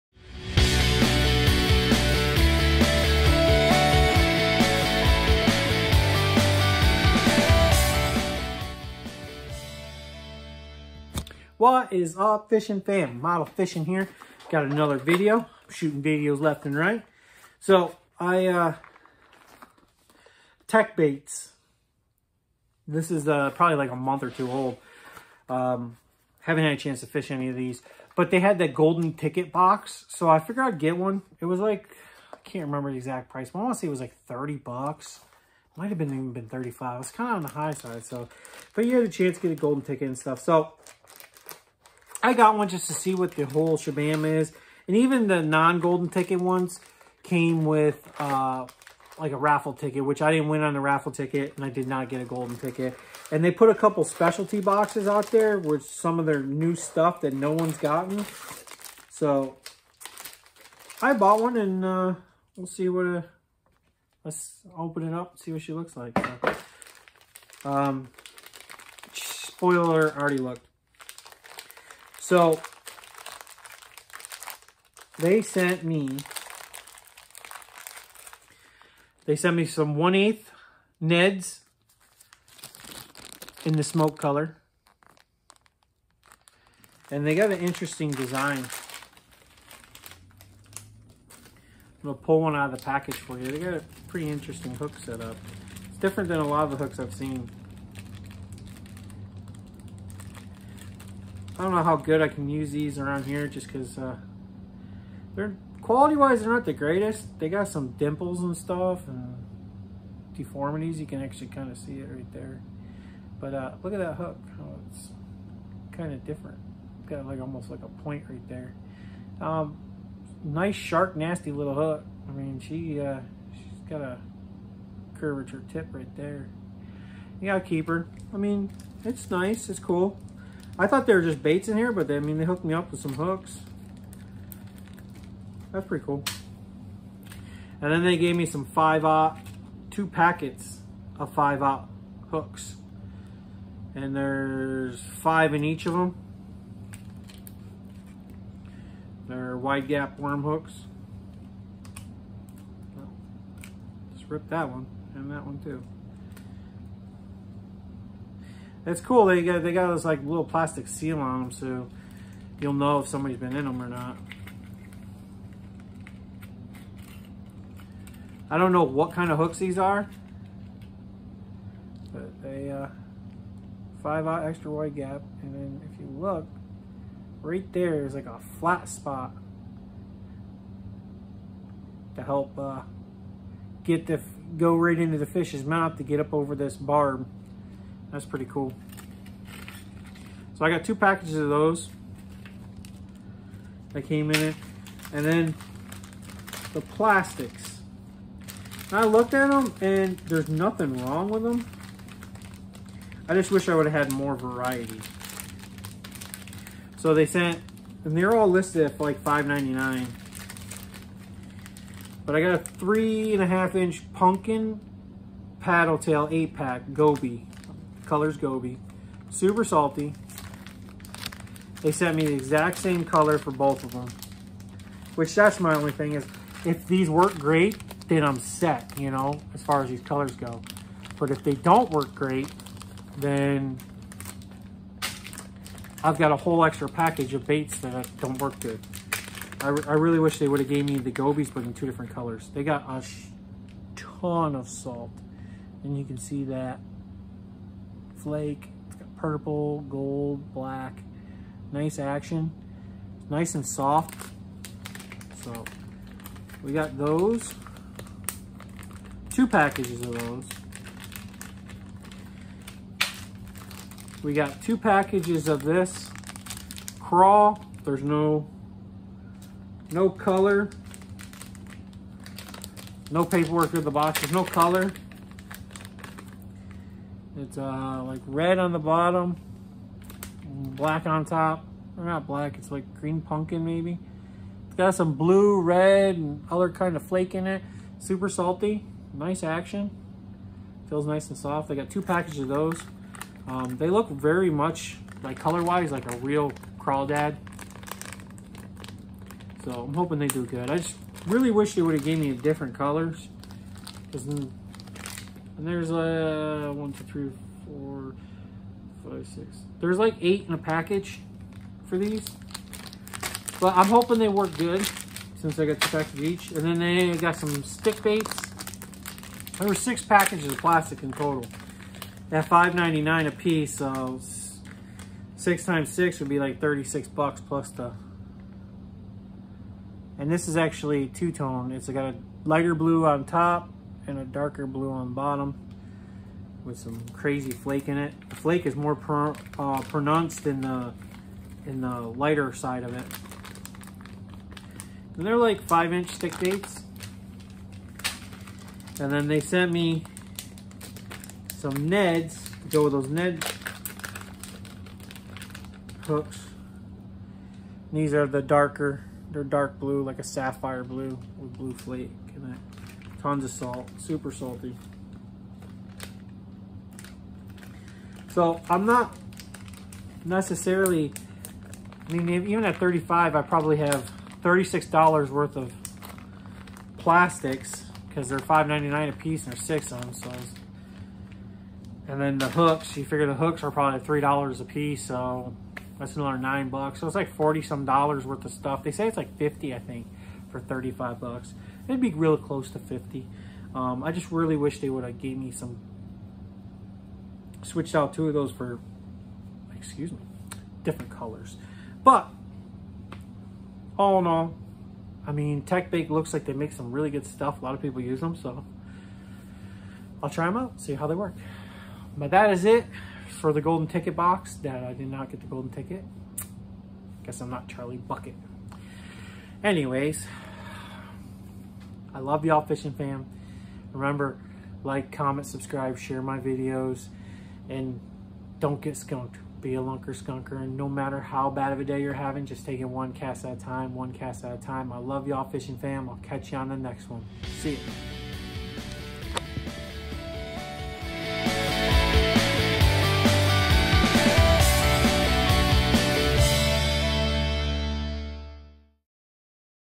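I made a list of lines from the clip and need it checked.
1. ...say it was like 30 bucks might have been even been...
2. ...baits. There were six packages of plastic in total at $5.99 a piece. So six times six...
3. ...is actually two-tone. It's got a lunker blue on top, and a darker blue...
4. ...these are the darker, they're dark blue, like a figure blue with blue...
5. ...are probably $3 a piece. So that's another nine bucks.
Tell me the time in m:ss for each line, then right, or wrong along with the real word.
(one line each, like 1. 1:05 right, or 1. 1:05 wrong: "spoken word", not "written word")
1. 0:33 right
2. 5:18 right
3. 5:30 wrong: "lighter", not "lunker"
4. 5:58 wrong: "sapphire", not "figure"
5. 6:23 right.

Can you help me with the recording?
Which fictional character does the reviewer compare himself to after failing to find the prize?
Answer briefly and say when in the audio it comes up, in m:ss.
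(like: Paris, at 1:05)
Charlie Bucket, at 6:57.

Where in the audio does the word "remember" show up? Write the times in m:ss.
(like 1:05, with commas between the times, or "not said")
0:32, 7:03.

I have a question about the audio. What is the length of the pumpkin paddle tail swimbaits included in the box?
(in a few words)
3.5 inch.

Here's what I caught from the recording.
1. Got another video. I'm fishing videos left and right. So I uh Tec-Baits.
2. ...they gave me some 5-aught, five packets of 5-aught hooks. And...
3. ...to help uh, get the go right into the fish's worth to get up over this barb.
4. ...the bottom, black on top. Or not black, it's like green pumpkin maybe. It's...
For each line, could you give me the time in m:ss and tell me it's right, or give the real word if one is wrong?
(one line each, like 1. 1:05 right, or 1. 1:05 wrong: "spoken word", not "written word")
1. 0:14 wrong: "shooting", not "fishing"
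2. 2:18 wrong: "two", not "five"
3. 3:02 wrong: "mouth", not "worth"
4. 4:38 right.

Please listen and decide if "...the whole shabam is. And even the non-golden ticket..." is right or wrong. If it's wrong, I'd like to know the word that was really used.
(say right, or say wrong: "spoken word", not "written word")
right.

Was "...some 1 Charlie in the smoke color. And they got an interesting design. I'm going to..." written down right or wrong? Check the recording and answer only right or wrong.
wrong.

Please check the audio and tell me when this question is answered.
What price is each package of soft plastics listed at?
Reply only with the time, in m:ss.
3:28.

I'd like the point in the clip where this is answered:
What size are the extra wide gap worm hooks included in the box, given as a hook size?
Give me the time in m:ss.
2:54.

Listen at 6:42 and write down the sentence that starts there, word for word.
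But, all in all, I mean, Tec-Bait looks like they make some really good stuff.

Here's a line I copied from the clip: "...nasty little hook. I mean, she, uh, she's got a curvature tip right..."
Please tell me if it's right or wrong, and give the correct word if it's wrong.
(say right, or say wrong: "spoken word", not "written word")
right.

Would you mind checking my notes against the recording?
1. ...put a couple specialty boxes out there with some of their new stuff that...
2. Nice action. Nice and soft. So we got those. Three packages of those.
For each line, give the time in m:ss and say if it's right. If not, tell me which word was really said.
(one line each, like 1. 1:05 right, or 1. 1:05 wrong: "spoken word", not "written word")
1. 0:53 right
2. 4:11 wrong: "Two", not "Three".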